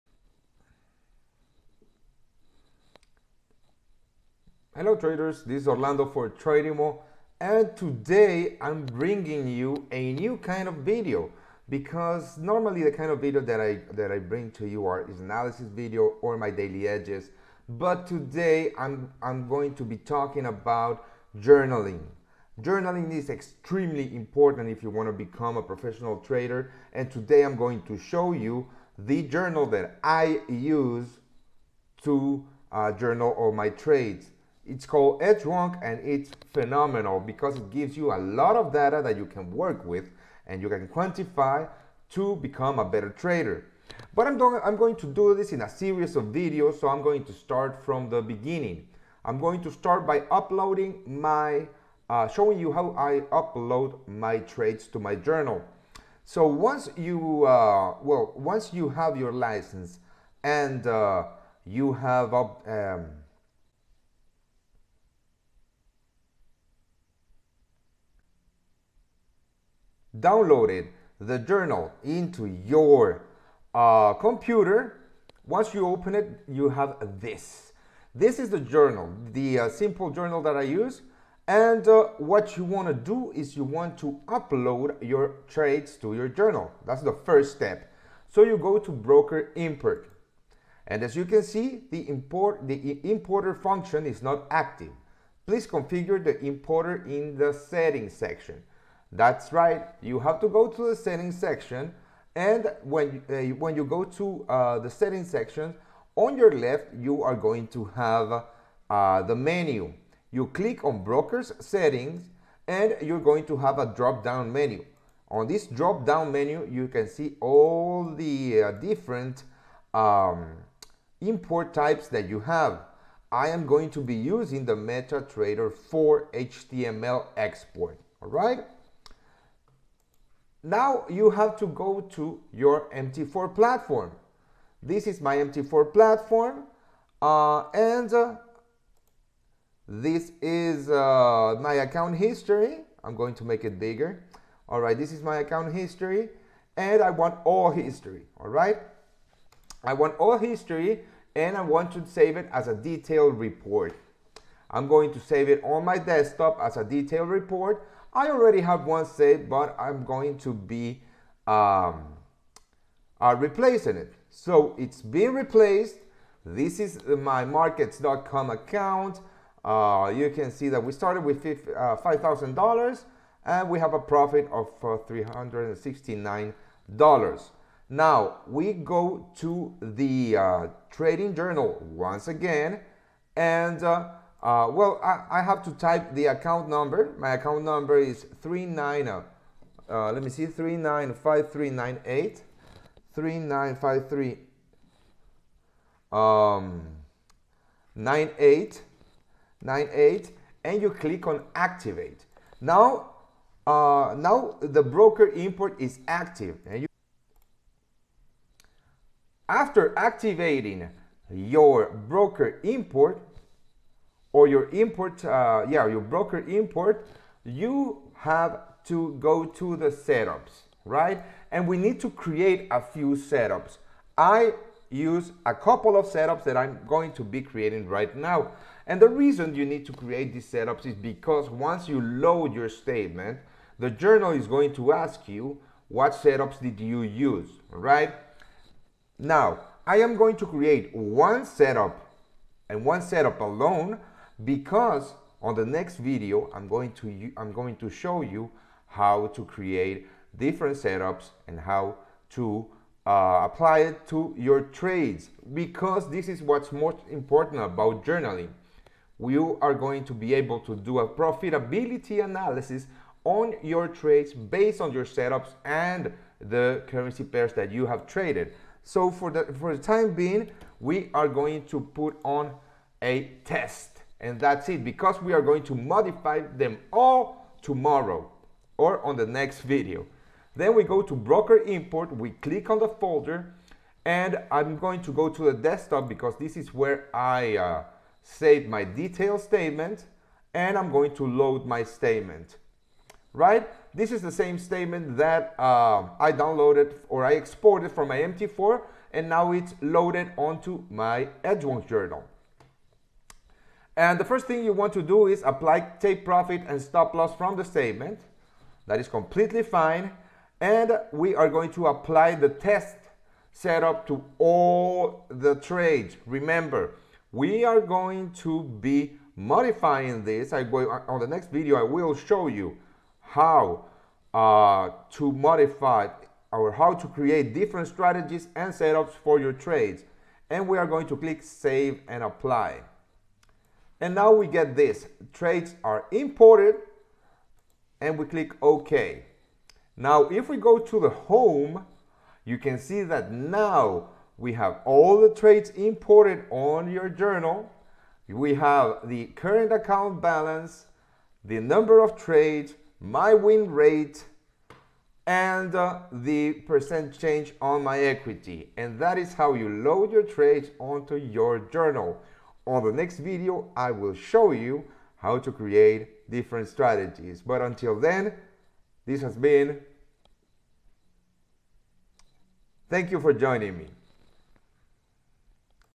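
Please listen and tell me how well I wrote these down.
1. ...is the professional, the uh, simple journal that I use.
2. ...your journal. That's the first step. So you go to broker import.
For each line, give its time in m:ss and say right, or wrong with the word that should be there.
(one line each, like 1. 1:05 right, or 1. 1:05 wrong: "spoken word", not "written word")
1. 1:18 wrong: "journal", not "professional"
2. 1:26 right.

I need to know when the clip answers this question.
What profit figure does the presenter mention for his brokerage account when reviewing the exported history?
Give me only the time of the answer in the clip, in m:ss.
2:55.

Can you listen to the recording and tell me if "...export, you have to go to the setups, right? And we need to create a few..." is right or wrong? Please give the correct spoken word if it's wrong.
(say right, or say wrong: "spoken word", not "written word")
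wrong: "import", not "export".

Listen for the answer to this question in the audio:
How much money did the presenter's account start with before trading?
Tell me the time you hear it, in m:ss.
2:52.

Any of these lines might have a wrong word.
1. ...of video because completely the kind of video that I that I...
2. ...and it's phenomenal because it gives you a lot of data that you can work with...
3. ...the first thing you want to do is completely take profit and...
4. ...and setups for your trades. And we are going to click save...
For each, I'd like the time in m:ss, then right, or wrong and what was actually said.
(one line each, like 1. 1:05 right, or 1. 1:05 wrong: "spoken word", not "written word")
1. 0:10 wrong: "normally", not "completely"
2. 0:35 right
3. 5:04 wrong: "apply", not "completely"
4. 5:28 right.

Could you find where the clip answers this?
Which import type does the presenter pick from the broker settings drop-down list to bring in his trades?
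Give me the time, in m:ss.
2:04.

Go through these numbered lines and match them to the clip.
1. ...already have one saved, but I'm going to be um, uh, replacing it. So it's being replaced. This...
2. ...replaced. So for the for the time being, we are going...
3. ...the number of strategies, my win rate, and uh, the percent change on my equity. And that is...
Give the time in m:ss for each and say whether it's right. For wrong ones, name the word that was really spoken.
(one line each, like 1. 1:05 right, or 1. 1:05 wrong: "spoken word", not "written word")
1. 2:38 right
2. 4:28 wrong: "traded", not "replaced"
3. 5:51 wrong: "trades", not "strategies".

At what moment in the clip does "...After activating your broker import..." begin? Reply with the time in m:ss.
3:29.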